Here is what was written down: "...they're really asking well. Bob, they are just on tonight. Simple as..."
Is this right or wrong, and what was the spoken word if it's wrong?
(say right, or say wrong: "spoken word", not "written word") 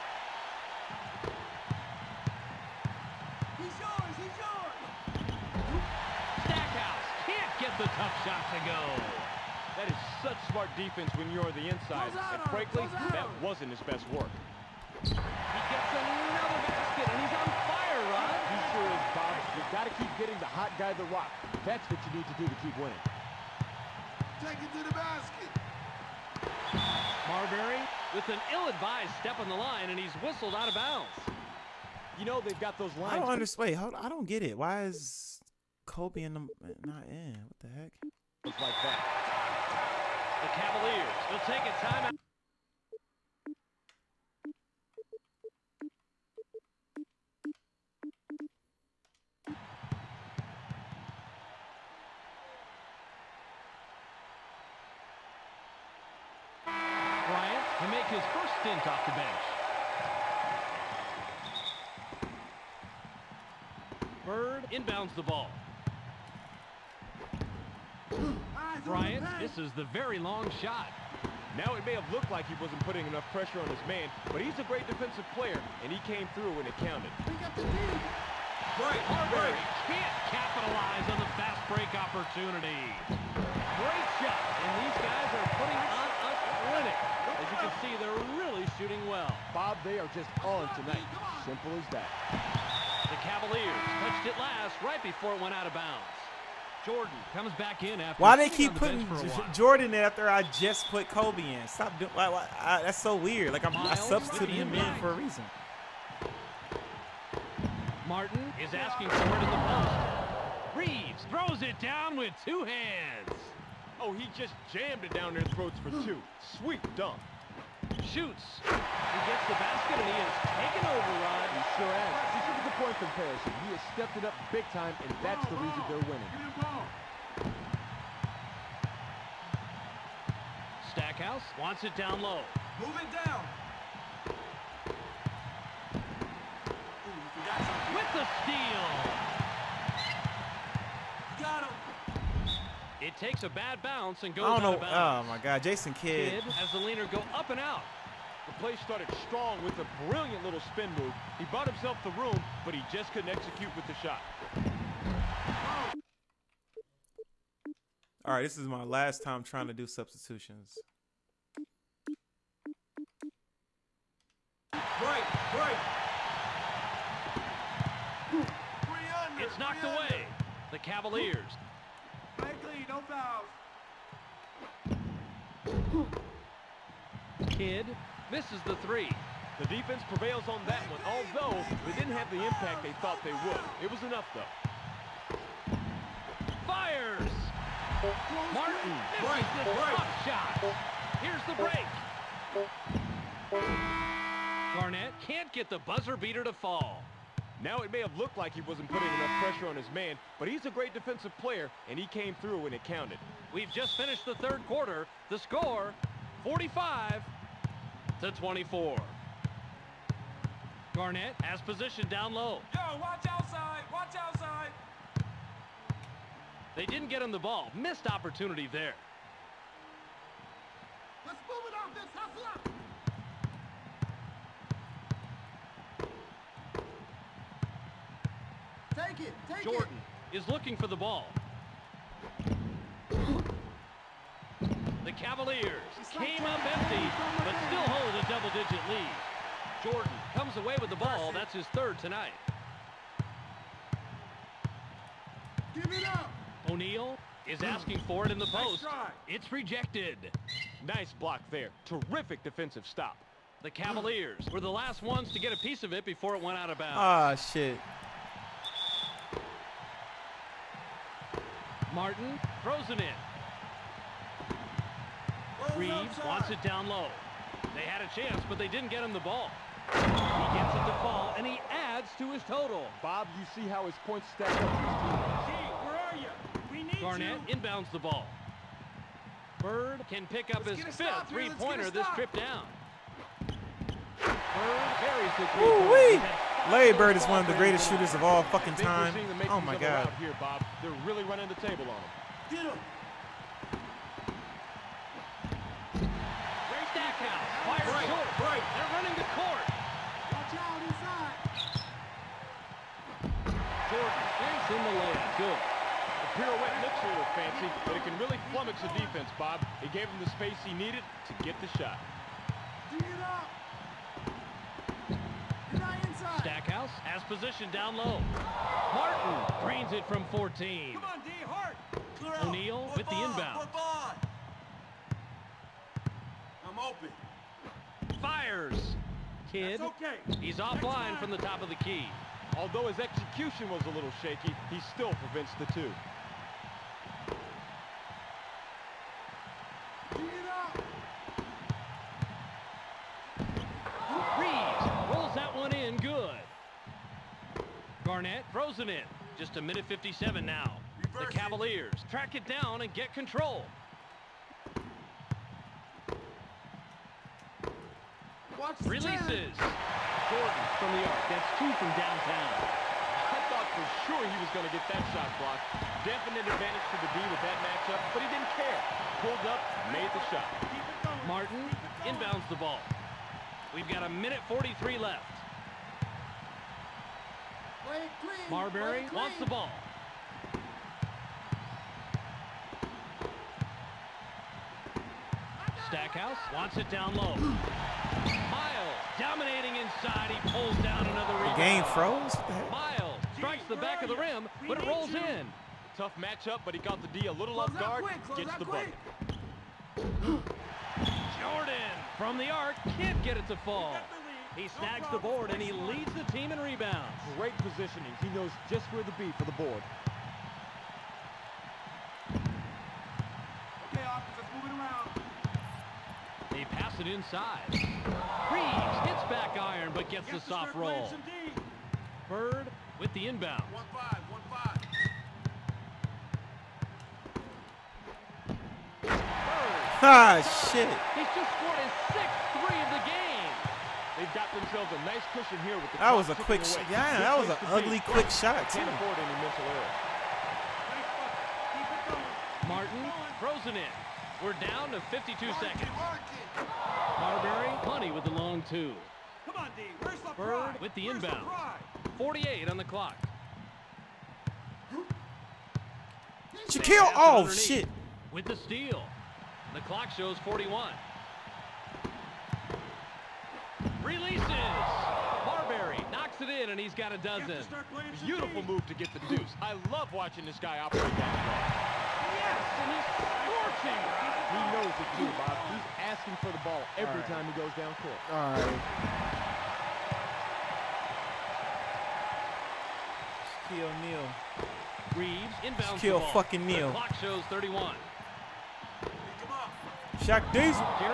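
wrong: "shooting", not "asking".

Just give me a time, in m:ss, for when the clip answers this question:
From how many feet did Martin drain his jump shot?
5:20.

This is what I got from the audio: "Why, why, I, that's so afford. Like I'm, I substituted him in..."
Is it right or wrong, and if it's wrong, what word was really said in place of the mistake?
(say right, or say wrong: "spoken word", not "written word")
wrong: "weird", not "afford".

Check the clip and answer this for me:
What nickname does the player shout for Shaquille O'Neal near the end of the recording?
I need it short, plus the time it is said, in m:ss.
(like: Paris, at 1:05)
Shaq Diesel, at 8:10.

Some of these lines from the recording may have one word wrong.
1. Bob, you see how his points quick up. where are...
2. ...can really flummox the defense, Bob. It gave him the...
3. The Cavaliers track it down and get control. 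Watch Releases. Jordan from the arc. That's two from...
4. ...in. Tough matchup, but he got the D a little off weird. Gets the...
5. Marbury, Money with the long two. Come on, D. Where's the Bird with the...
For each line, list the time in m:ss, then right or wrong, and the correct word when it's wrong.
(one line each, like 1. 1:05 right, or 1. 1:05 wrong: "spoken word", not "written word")
1. 4:33 wrong: "stack", not "quick"
2. 5:08 right
3. 5:51 right
4. 6:35 wrong: "guard", not "weird"
5. 7:27 right.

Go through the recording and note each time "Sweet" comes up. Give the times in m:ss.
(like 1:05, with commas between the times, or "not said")
1:56.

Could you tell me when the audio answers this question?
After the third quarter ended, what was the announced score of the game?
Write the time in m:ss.
3:26.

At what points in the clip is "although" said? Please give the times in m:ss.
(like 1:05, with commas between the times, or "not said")
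3:01, 5:32.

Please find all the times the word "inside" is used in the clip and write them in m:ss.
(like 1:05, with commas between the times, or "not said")
0:11, 6:29, 6:57.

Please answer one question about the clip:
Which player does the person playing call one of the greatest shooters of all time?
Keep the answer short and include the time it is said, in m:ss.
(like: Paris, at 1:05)
Larry Bird, at 4:46.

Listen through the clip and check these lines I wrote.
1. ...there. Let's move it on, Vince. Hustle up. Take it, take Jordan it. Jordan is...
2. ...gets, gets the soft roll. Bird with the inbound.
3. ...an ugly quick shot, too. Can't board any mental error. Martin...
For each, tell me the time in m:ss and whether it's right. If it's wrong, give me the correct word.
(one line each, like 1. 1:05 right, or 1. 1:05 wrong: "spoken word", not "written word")
1. 3:38 right
2. 7:00 right
3. 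7:17 wrong: "afford", not "board".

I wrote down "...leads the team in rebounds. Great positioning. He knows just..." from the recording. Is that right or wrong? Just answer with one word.
right.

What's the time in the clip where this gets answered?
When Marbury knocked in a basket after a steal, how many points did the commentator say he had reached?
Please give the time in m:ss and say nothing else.
7:47.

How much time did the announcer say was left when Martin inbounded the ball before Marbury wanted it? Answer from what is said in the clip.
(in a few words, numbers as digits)
1:43.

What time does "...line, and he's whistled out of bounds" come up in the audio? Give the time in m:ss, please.
0:29.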